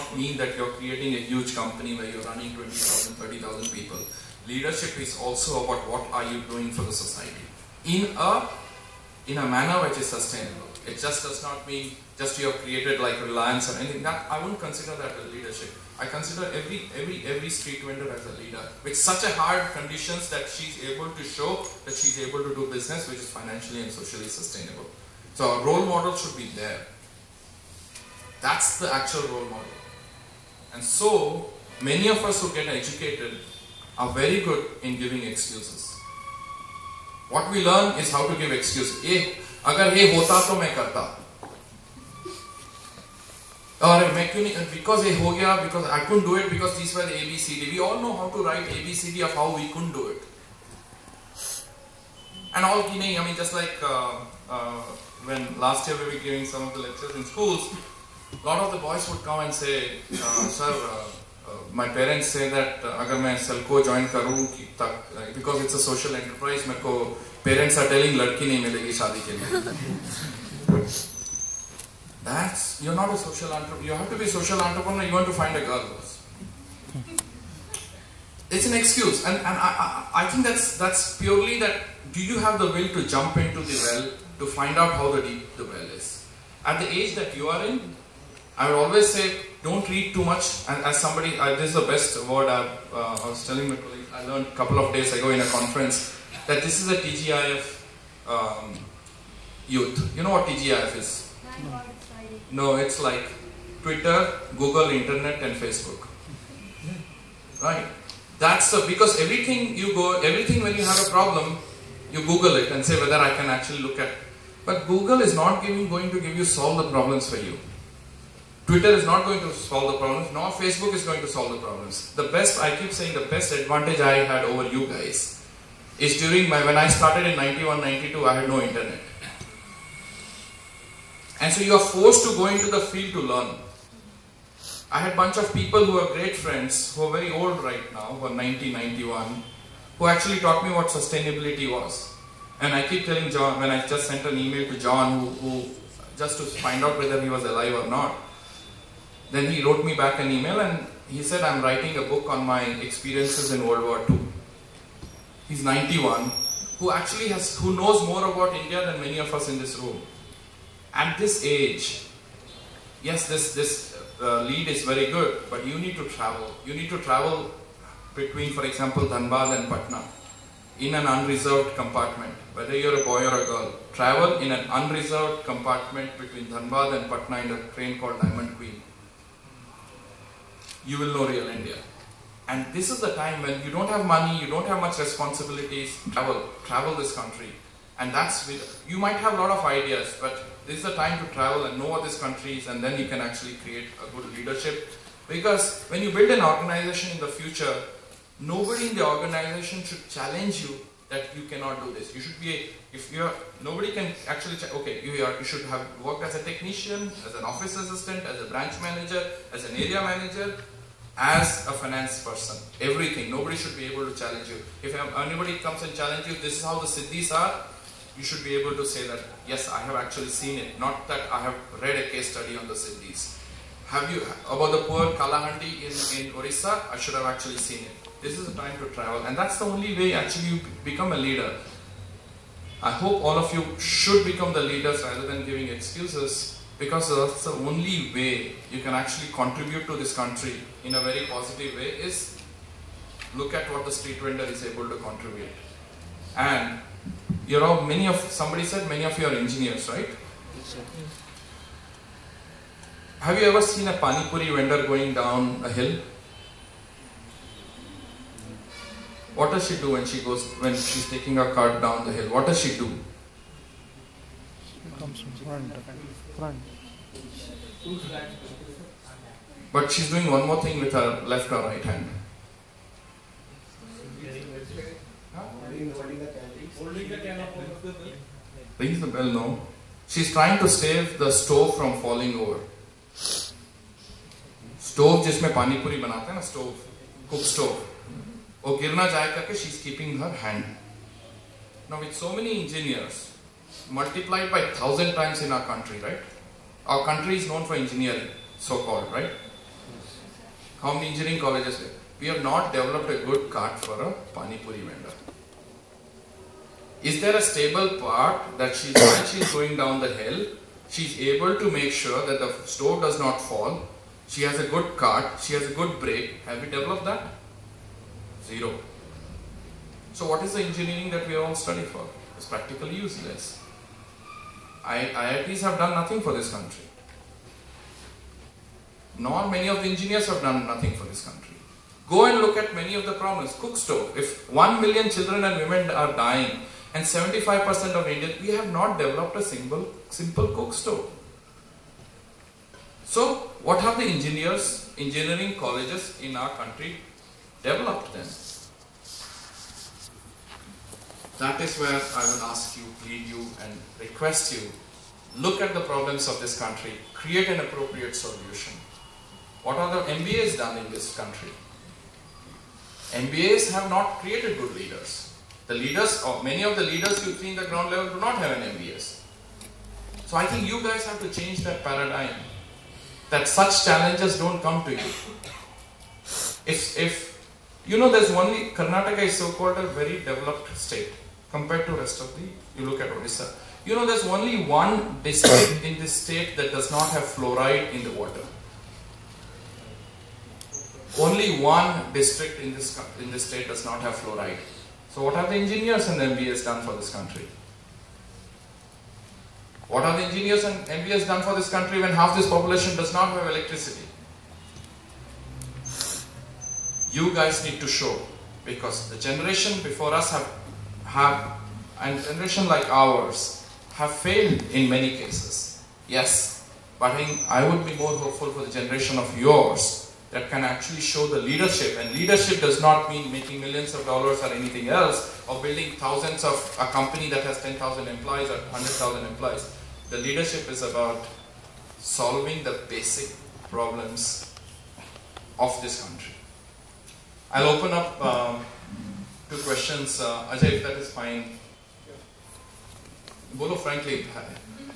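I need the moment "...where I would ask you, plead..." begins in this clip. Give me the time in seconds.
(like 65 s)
351 s.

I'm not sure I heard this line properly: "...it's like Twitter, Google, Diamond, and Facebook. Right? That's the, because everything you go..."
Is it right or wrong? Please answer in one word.
wrong.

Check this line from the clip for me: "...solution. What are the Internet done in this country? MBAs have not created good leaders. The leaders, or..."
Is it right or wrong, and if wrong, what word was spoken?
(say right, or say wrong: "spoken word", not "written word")
wrong: "MBAs", not "Internet".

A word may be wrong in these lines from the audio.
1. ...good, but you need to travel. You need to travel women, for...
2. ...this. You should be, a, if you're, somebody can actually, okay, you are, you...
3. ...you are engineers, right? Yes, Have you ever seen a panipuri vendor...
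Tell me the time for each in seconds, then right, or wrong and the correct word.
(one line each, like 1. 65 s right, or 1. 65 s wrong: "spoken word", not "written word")
1. 165 s wrong: "between", not "women"
2. 201 s wrong: "nobody", not "somebody"
3. 249 s right.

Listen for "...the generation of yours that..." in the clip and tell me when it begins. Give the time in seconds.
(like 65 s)
418 s.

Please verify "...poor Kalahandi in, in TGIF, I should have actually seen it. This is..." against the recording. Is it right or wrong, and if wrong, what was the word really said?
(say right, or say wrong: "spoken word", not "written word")
wrong: "Orissa", not "TGIF".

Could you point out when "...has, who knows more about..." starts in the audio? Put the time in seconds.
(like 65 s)
157 s.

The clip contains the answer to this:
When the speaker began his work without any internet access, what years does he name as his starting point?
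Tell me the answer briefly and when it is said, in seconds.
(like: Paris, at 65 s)
1991-92, at 127 s.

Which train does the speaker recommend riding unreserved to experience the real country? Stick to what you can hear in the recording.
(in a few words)
Diamond Queen.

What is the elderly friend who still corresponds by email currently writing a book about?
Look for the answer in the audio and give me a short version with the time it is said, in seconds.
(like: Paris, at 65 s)
World War II, at 153 s.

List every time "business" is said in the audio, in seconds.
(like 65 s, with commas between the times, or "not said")
22 s.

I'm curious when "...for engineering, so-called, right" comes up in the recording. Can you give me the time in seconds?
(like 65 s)
297 s.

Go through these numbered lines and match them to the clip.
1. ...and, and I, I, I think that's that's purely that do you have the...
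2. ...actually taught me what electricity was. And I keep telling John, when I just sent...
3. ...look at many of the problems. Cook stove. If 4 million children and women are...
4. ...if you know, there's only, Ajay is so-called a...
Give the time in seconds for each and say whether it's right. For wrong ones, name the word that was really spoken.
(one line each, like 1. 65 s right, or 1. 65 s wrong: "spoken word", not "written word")
1. 79 s right
2. 140 s wrong: "sustainability", not "electricity"
3. 332 s wrong: "1", not "4"
4. 376 s wrong: "Karnataka", not "Ajay".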